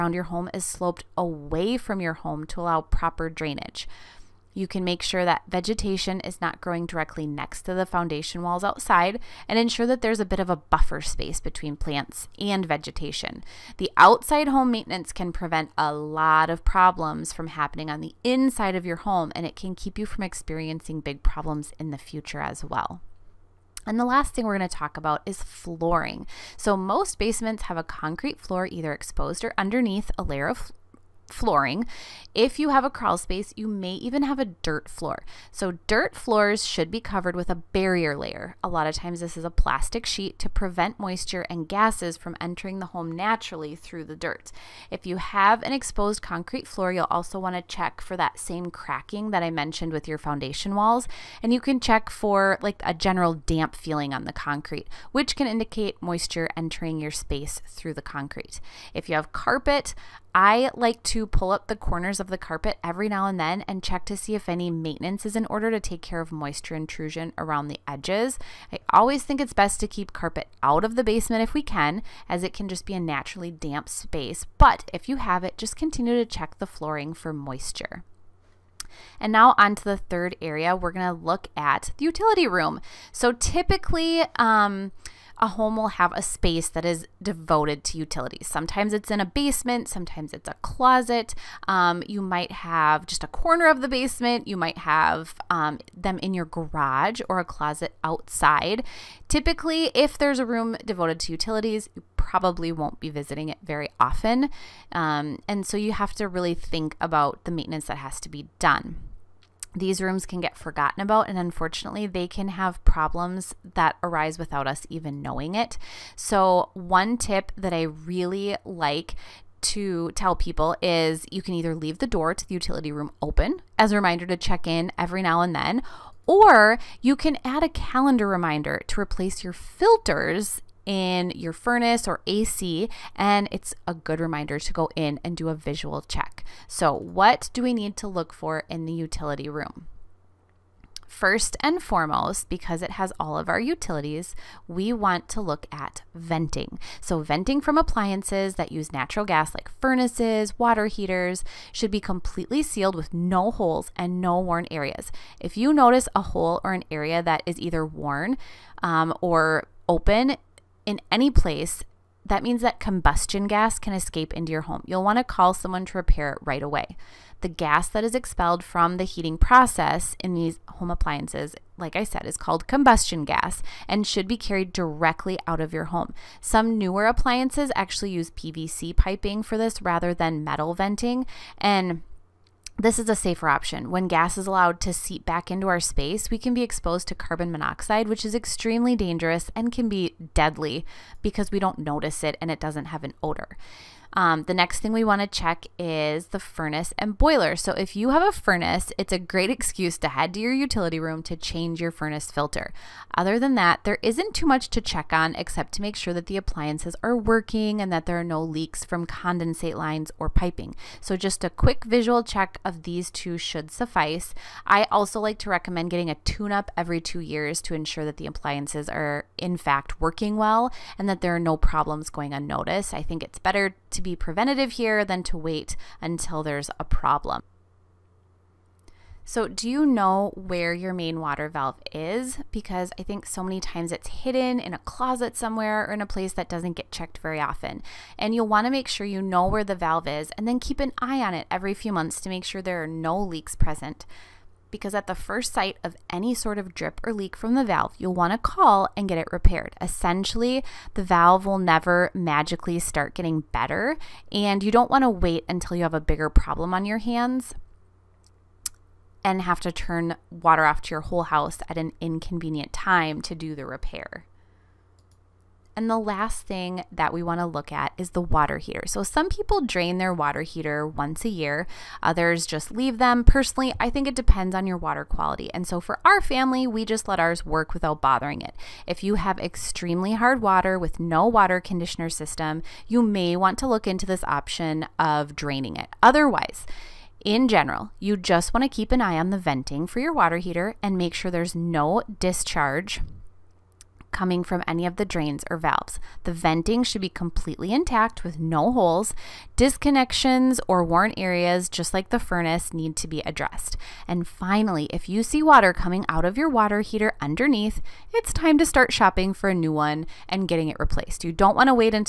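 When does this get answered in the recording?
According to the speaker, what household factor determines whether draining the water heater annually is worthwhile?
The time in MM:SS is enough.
04:34.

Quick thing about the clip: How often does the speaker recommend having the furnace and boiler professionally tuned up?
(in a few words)
every 2 years.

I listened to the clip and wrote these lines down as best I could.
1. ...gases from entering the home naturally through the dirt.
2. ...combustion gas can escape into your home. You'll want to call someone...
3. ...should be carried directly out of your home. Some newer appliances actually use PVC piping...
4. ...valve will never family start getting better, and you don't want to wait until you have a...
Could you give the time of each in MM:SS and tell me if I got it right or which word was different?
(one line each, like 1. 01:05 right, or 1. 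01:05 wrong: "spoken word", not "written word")
1. 00:41 right
2. 02:42 right
3. 02:54 right
4. 04:11 wrong: "magically", not "family".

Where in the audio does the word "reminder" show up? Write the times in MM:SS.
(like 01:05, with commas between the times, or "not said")
02:03, 02:08, 02:14.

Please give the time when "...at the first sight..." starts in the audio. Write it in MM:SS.
04:04.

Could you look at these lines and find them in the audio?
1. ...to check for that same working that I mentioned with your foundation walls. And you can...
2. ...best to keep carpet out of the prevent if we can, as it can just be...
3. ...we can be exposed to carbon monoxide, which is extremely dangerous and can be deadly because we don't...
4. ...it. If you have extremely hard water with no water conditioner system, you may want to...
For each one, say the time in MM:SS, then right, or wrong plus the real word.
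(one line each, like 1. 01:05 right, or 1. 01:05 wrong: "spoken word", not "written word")
1. 00:47 wrong: "cracking", not "working"
2. 01:09 wrong: "basement", not "prevent"
3. 03:06 right
4. 04:38 right.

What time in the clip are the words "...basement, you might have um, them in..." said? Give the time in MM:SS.
01:33.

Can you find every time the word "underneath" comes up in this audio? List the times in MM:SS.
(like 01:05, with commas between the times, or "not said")
00:29, 05:07.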